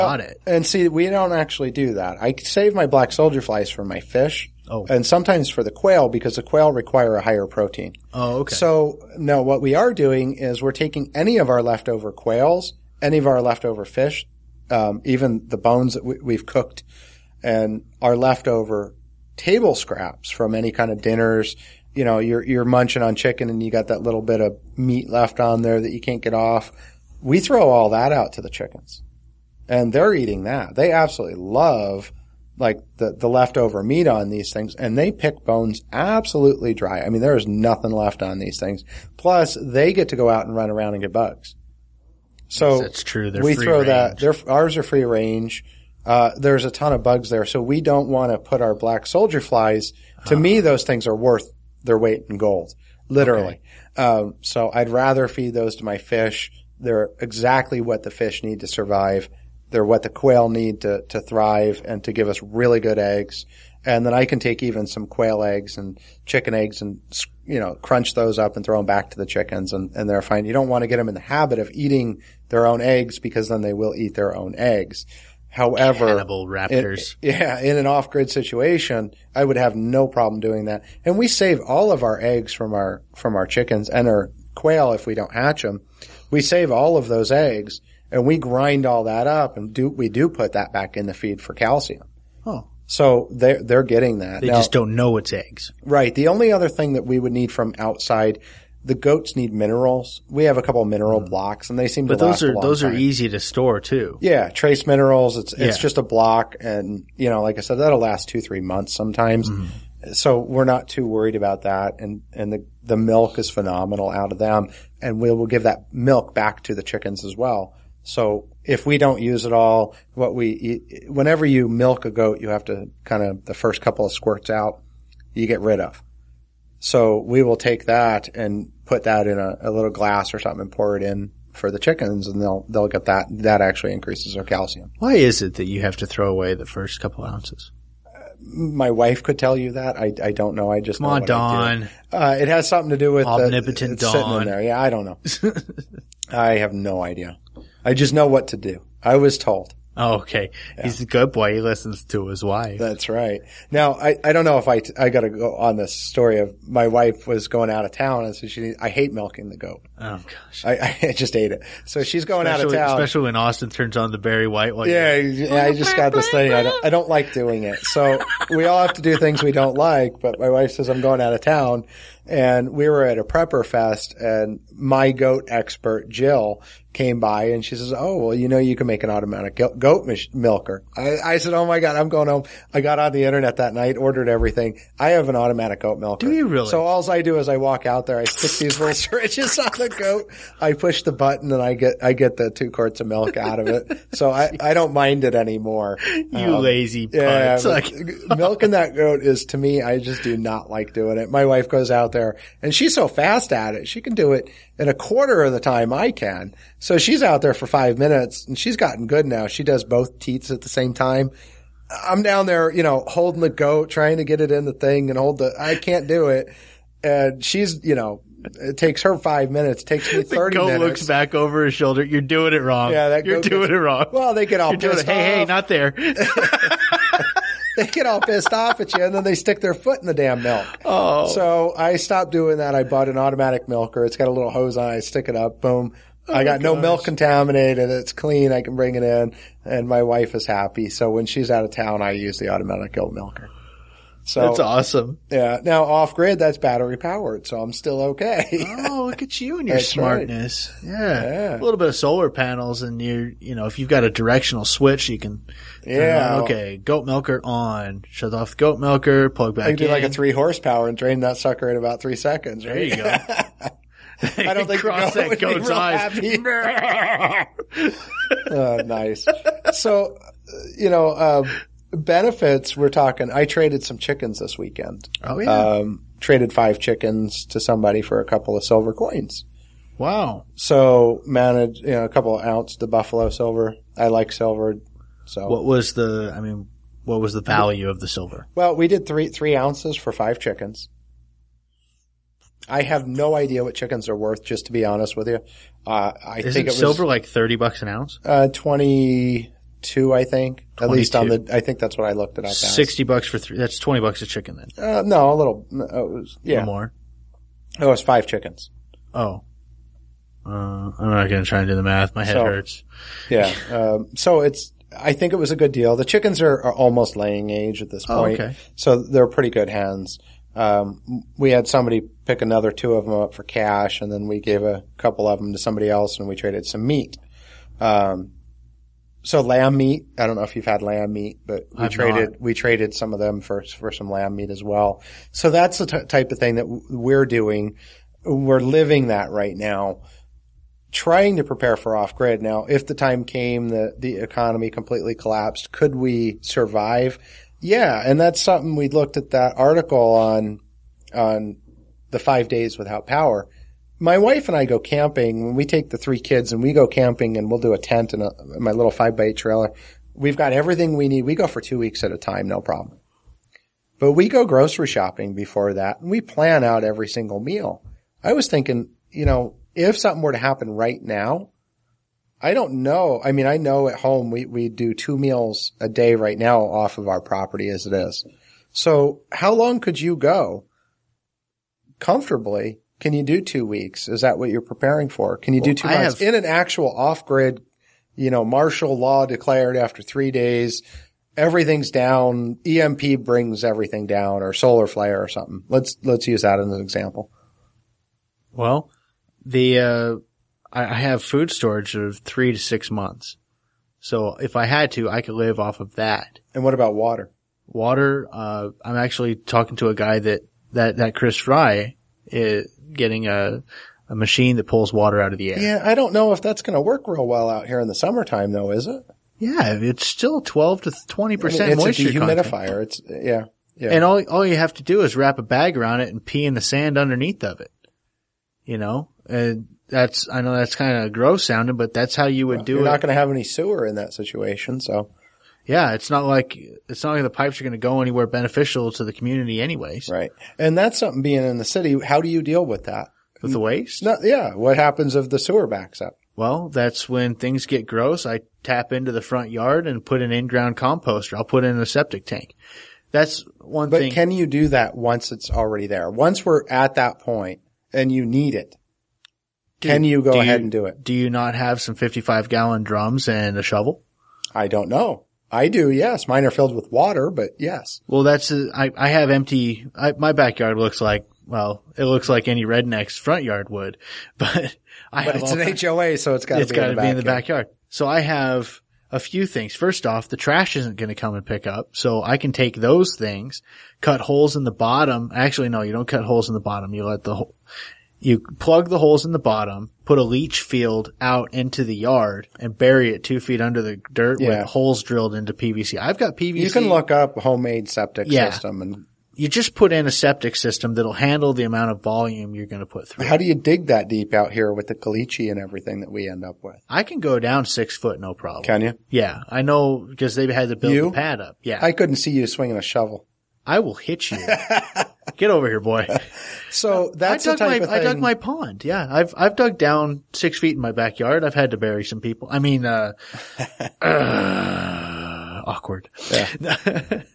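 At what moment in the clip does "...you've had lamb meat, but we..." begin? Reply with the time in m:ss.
5:30.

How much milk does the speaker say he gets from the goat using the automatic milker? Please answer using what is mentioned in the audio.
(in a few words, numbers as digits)
2 quarts.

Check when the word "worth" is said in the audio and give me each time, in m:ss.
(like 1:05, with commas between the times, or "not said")
0:51, 4:54.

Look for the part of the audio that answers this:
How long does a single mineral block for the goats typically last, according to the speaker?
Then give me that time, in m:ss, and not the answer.
1:48.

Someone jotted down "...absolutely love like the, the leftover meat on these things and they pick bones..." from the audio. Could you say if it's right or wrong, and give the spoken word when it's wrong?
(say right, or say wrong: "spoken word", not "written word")
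right.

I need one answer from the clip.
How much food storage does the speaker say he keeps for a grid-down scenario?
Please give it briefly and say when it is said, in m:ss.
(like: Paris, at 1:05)
3 to 6 months, at 6:42.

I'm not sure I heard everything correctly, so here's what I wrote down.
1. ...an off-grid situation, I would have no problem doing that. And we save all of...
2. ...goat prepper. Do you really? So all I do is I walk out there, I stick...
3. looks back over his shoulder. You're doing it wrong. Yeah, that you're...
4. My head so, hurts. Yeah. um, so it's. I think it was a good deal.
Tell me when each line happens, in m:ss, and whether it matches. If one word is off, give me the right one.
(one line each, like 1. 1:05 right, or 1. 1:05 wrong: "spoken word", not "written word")
1. 1:17 right
2. 3:05 wrong: "milker", not "prepper"
3. 3:40 right
4. 5:12 right.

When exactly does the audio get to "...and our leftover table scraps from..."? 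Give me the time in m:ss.
0:17.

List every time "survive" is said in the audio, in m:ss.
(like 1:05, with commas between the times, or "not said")
0:58, 5:46.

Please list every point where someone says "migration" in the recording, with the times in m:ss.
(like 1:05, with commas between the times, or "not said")
not said.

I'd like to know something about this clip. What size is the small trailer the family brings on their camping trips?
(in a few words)
5 by 8.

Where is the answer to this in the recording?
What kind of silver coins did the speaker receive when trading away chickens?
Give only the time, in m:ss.
4:42.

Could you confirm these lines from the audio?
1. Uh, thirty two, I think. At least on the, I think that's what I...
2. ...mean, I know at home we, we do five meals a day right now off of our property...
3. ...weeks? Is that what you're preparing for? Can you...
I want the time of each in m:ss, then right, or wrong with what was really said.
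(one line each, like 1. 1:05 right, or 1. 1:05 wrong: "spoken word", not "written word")
1. 4:58 wrong: "twenty", not "thirty"
2. 6:13 wrong: "two", not "five"
3. 6:23 right.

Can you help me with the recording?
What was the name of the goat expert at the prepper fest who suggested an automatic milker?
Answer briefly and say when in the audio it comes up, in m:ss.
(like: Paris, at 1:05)
Jill, at 2:56.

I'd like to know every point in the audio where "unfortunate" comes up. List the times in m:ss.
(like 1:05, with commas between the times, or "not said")
not said.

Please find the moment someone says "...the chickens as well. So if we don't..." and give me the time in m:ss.
1:56.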